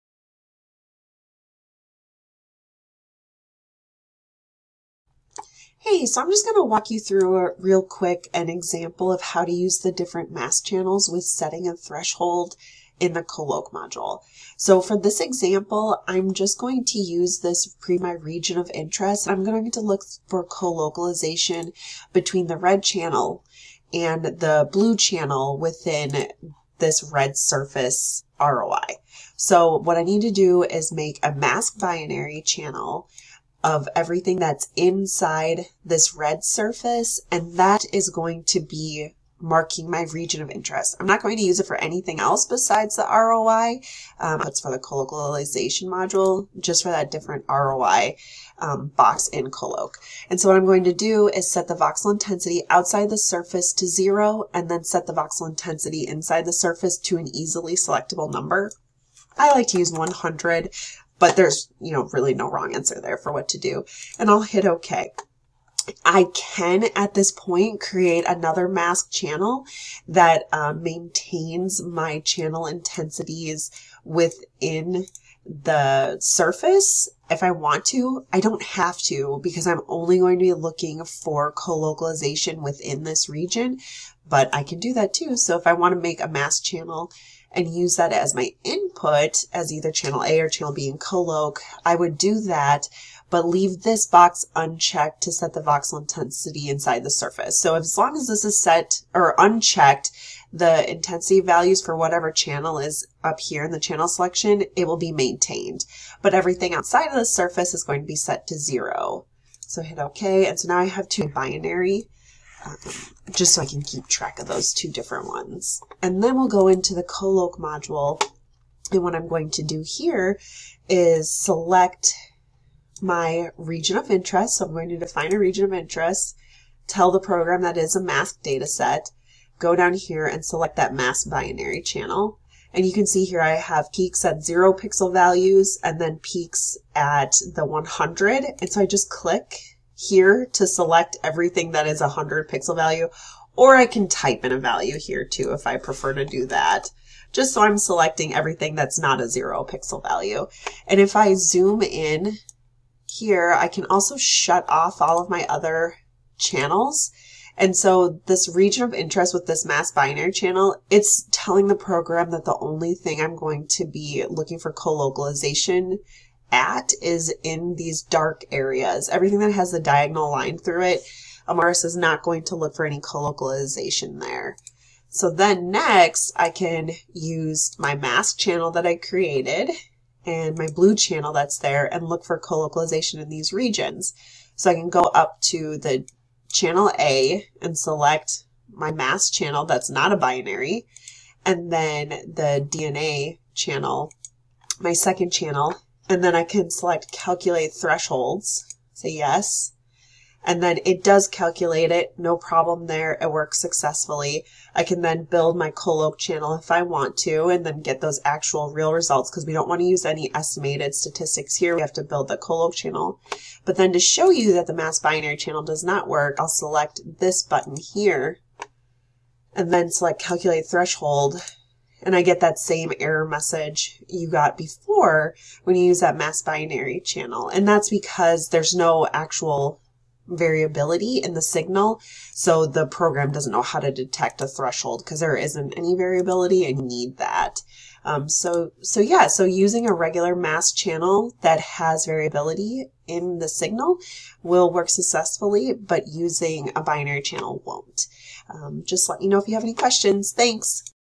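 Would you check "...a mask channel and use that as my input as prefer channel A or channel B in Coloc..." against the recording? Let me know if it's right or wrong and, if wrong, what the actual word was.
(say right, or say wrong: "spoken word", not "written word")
wrong: "either", not "prefer".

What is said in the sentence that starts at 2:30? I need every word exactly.
And if I zoom in here, I can also shut off all of my other channels.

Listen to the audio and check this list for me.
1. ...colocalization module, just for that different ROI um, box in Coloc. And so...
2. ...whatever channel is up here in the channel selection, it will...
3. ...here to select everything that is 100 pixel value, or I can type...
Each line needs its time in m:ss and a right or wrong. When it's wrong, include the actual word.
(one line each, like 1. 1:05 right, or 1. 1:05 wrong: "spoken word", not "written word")
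1. 0:44 right
2. 1:41 right
3. 2:20 right.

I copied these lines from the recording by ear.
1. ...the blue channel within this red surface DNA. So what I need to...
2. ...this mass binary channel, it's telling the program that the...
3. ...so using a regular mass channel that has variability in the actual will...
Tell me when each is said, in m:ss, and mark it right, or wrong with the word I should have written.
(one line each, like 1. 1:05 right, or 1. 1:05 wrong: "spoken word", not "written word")
1. 0:24 wrong: "ROI", not "DNA"
2. 2:39 right
3. 3:59 wrong: "signal", not "actual".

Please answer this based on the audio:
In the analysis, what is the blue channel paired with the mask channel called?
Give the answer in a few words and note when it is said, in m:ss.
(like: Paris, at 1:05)
DNA channel, at 3:12.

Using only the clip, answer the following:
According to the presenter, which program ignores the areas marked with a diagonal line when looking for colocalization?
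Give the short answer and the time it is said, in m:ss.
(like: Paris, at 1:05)
Imaris, at 2:51.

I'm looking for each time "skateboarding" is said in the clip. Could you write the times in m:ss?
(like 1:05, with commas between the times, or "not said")
not said.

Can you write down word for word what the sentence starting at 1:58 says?
And what I'm going to do here is select my region of interest.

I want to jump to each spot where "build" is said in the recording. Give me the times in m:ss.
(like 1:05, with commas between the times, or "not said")
3:25, 3:32.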